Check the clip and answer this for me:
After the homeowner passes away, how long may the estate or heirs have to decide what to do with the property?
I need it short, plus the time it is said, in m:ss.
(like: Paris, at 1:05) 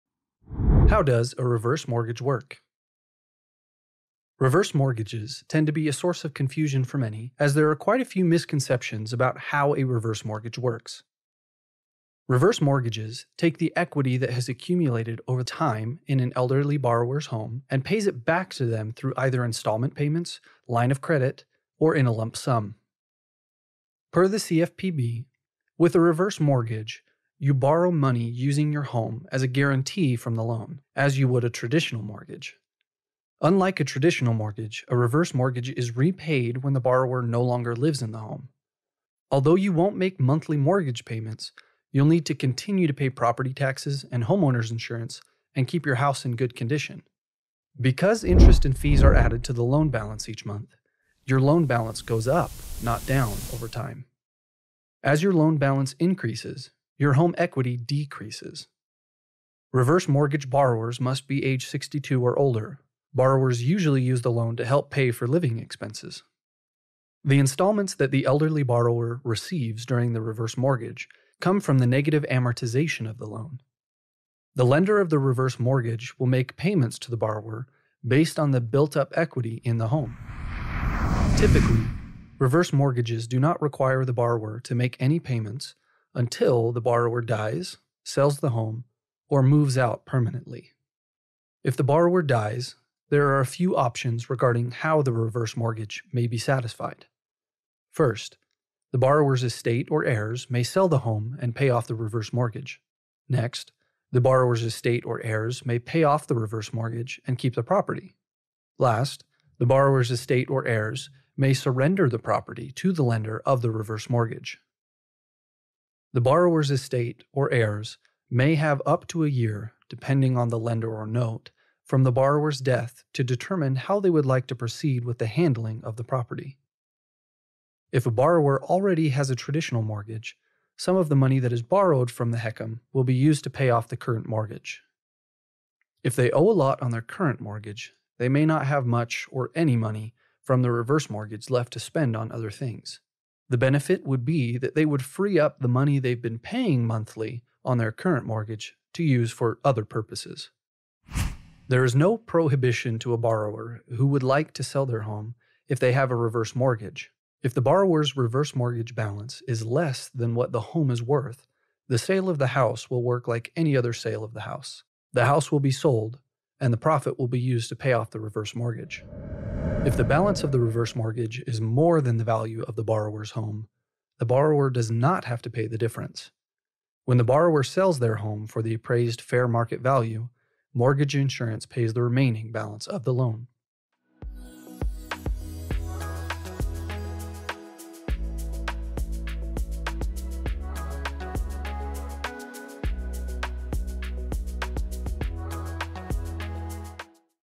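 Up to a year, at 1:58.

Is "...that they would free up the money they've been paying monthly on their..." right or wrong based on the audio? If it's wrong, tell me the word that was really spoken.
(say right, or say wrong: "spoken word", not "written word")
right.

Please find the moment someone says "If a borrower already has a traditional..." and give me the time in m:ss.
2:07.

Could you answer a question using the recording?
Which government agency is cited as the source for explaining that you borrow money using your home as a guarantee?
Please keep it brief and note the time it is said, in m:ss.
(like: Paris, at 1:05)
CFPB, at 0:24.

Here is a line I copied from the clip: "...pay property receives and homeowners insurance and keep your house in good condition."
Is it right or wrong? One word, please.
wrong.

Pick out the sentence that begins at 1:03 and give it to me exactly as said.
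Borrowers usually use the loan to help pay for living expenses.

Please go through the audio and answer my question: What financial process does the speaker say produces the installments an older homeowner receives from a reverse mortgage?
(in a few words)
Negative amortization.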